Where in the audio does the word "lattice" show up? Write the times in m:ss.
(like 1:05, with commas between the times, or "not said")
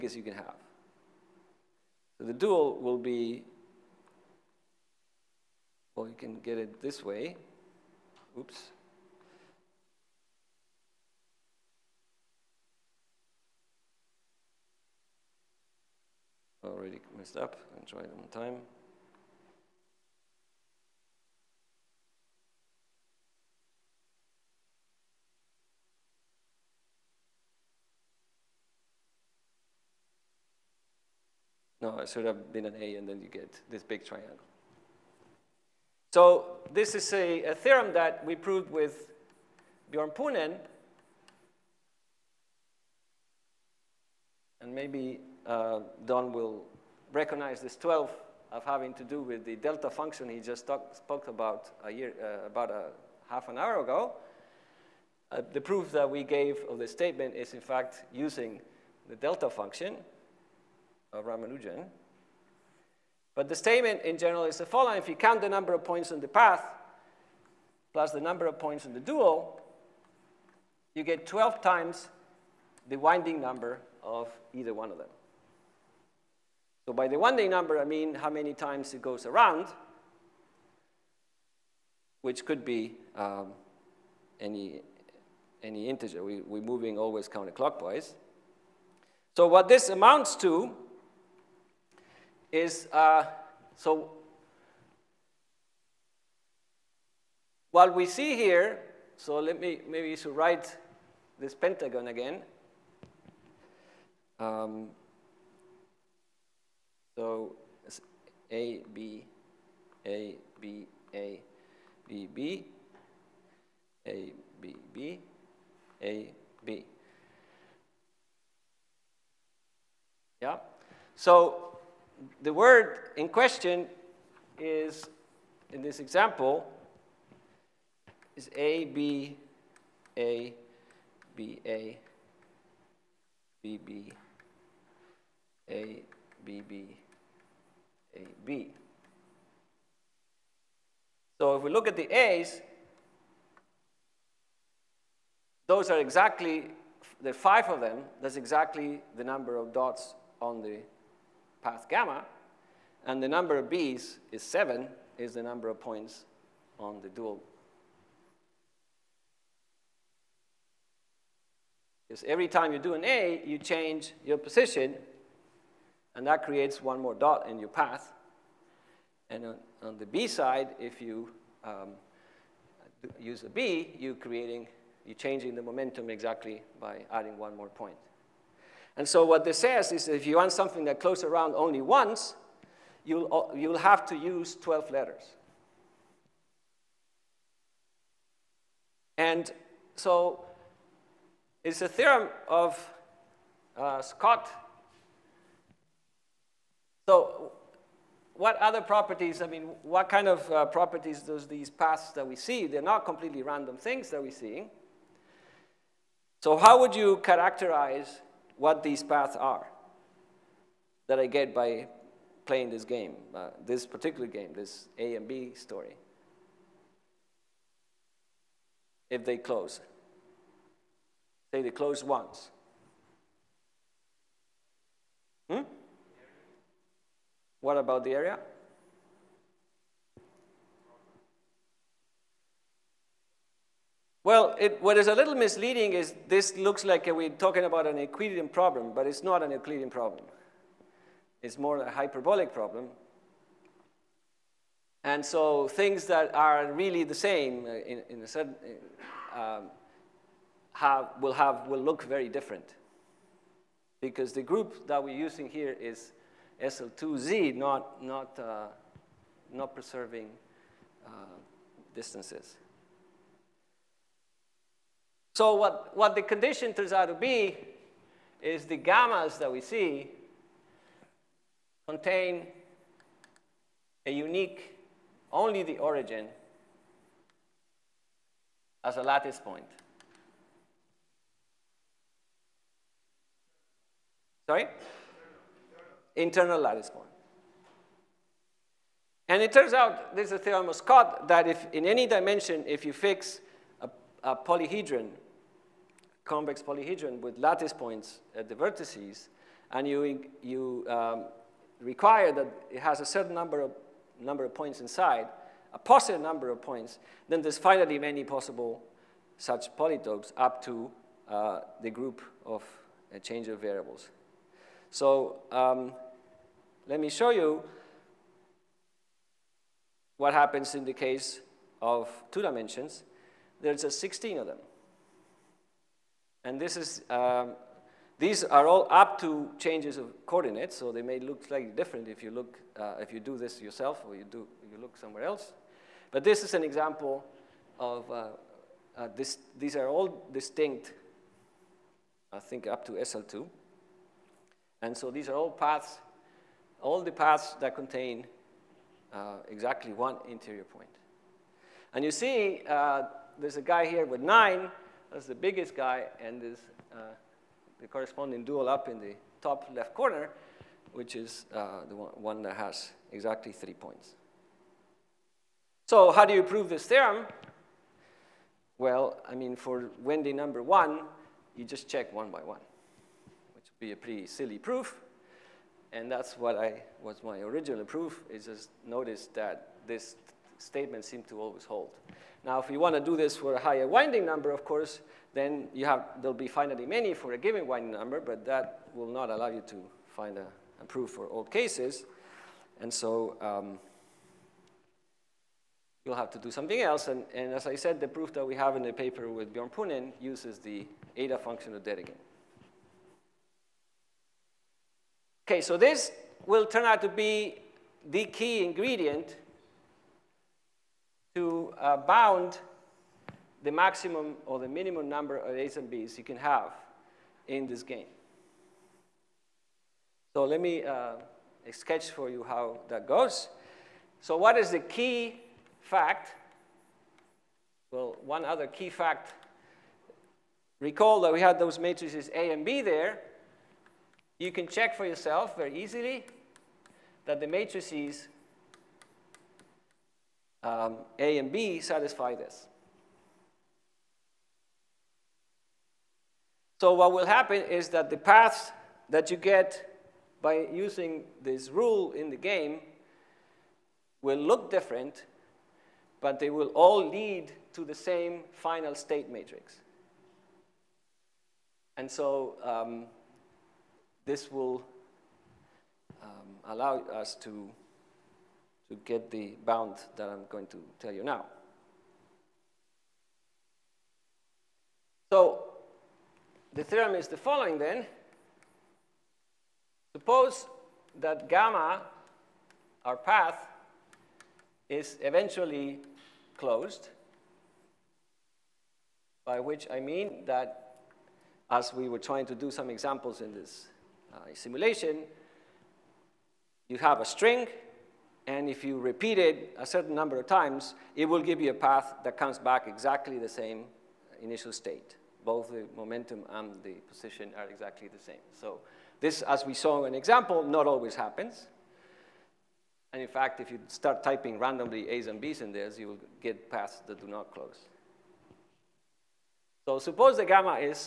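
4:39, 4:46, 4:57.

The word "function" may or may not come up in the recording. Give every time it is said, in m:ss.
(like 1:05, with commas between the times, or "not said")
0:49, 0:59, 6:41.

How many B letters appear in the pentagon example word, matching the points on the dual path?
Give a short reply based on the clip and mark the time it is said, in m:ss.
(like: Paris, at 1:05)
7, at 2:34.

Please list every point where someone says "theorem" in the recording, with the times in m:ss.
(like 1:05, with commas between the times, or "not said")
0:37, 3:11, 4:50, 6:06, 7:56.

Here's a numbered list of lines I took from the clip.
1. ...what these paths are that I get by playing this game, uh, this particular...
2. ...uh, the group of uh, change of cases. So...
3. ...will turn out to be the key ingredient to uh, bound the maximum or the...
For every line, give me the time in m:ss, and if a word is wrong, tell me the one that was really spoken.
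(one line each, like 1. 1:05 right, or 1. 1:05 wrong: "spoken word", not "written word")
1. 3:28 right
2. 5:11 wrong: "variables", not "cases"
3. 6:46 right.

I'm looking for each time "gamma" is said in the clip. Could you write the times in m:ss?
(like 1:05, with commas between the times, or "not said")
2:31, 4:28, 8:01, 8:40.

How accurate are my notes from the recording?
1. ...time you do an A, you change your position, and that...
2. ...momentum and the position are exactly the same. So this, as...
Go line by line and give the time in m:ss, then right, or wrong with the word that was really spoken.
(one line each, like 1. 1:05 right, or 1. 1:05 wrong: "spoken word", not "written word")
1. 2:42 right
2. 8:25 right.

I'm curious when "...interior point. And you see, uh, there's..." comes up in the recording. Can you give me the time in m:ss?
5:50.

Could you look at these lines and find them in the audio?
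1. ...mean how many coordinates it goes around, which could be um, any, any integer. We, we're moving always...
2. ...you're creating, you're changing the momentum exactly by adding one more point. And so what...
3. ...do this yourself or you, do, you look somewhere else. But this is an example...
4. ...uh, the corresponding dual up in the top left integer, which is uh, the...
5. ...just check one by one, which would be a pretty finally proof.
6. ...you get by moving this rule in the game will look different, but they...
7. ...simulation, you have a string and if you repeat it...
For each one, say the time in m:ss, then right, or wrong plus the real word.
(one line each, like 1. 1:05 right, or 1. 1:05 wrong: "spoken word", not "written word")
1. 1:17 wrong: "times", not "coordinates"
2. 2:53 right
3. 5:33 right
4. 5:56 wrong: "corner", not "integer"
5. 6:11 wrong: "silly", not "finally"
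6. 7:29 wrong: "using", not "moving"
7. 8:14 right.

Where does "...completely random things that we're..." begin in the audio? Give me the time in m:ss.
3:23.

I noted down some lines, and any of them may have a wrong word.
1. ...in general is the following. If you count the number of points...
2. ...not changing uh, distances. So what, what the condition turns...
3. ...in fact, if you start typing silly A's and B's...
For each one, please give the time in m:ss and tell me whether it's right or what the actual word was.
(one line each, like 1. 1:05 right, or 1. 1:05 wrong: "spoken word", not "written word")
1. 1:04 right
2. 4:19 wrong: "preserving", not "changing"
3. 8:33 wrong: "randomly", not "silly".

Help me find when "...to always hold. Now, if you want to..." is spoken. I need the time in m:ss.
6:21.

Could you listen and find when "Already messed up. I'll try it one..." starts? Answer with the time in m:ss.
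0:16.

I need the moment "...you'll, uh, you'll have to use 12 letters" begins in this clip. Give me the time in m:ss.
3:03.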